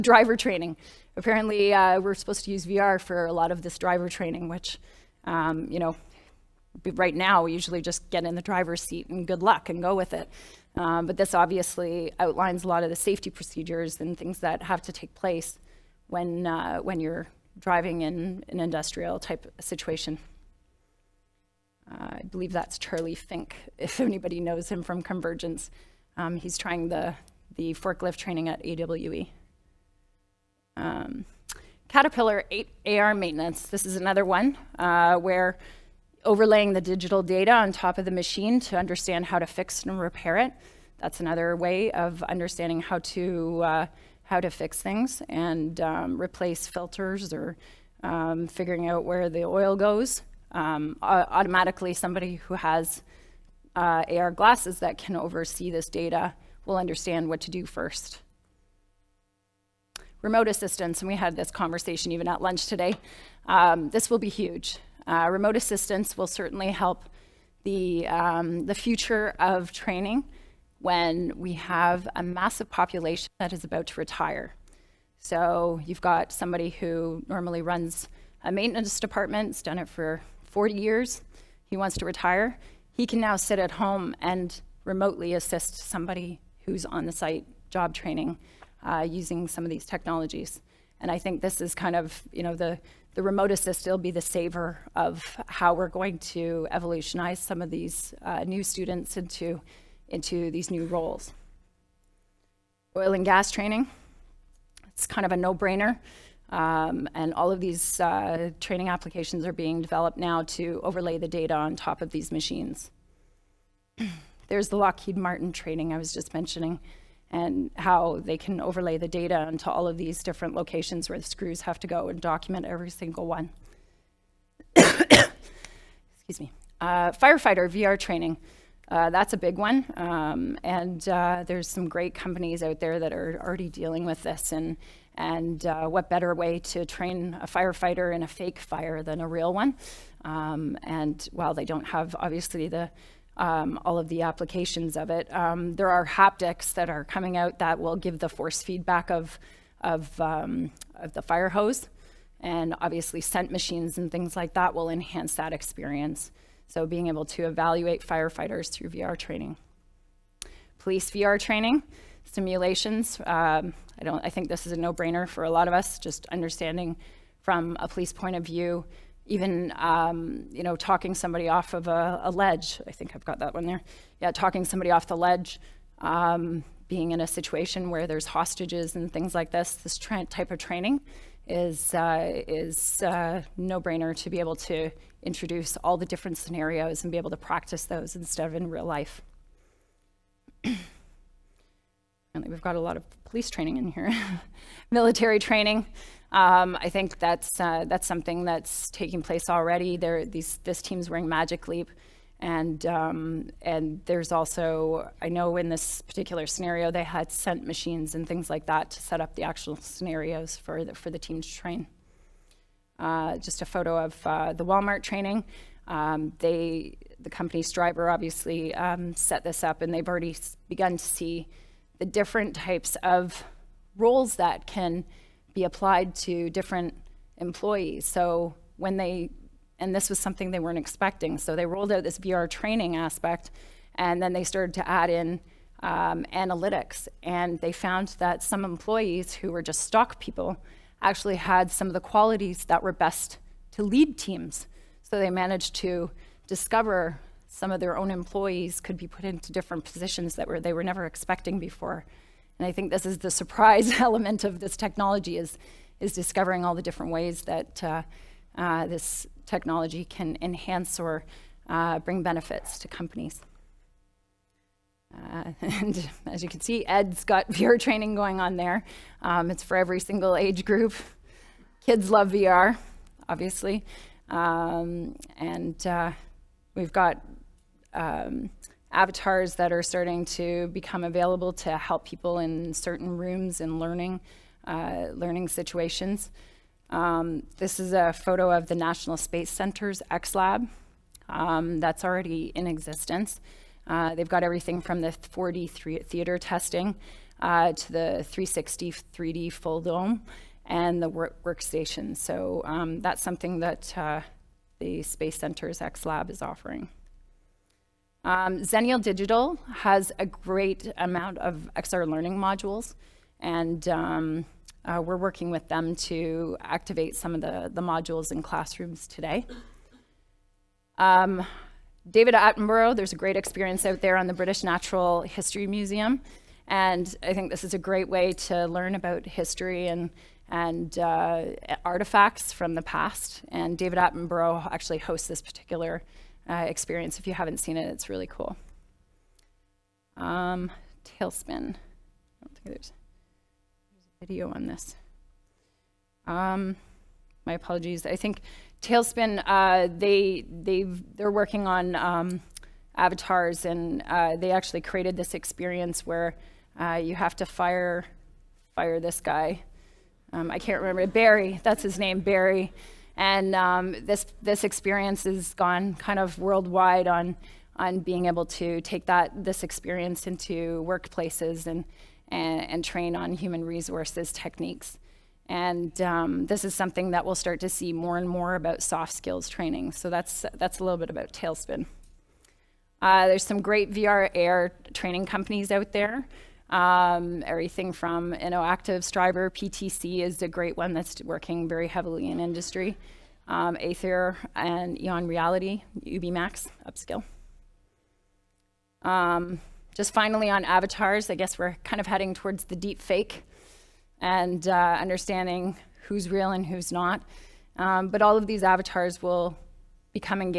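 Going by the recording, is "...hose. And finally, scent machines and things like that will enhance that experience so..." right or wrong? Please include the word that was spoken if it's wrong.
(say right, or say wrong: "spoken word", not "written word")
wrong: "obviously", not "finally".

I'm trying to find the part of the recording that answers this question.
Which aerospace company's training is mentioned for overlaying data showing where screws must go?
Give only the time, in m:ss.
1:54.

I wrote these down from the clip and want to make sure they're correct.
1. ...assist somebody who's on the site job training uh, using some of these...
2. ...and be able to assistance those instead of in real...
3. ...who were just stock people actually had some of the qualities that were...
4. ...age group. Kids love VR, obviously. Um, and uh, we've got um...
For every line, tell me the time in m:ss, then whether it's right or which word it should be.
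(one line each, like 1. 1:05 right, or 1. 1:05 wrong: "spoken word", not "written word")
1. 1:25 right
2. 3:07 wrong: "practice", not "assistance"
3. 3:59 right
4. 4:30 right.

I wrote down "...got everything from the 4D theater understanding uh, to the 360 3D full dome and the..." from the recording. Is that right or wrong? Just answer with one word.
wrong.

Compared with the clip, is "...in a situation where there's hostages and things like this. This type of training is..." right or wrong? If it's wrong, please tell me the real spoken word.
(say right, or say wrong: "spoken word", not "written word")
right.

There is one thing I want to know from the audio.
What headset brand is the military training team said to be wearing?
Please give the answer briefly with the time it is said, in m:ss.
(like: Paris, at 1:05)
Magic Leap, at 3:21.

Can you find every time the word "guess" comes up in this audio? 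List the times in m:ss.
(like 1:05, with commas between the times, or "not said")
6:41.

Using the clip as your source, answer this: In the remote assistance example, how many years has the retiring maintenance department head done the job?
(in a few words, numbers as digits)
40.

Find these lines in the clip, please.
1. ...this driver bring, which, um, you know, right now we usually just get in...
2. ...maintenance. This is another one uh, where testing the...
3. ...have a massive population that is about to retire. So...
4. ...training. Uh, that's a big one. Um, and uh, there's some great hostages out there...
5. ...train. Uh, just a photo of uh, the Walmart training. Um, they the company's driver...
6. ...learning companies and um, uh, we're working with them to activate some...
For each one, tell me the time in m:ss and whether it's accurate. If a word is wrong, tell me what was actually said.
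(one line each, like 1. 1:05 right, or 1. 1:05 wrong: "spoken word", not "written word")
1. 0:03 wrong: "training", not "bring"
2. 0:33 wrong: "overlaying", not "testing"
3. 1:11 right
4. 2:07 wrong: "companies", not "hostages"
5. 3:31 right
6. 5:12 wrong: "modules", not "companies".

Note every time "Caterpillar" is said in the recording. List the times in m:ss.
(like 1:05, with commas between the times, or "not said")
0:31.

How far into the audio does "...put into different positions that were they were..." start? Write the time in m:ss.
4:09.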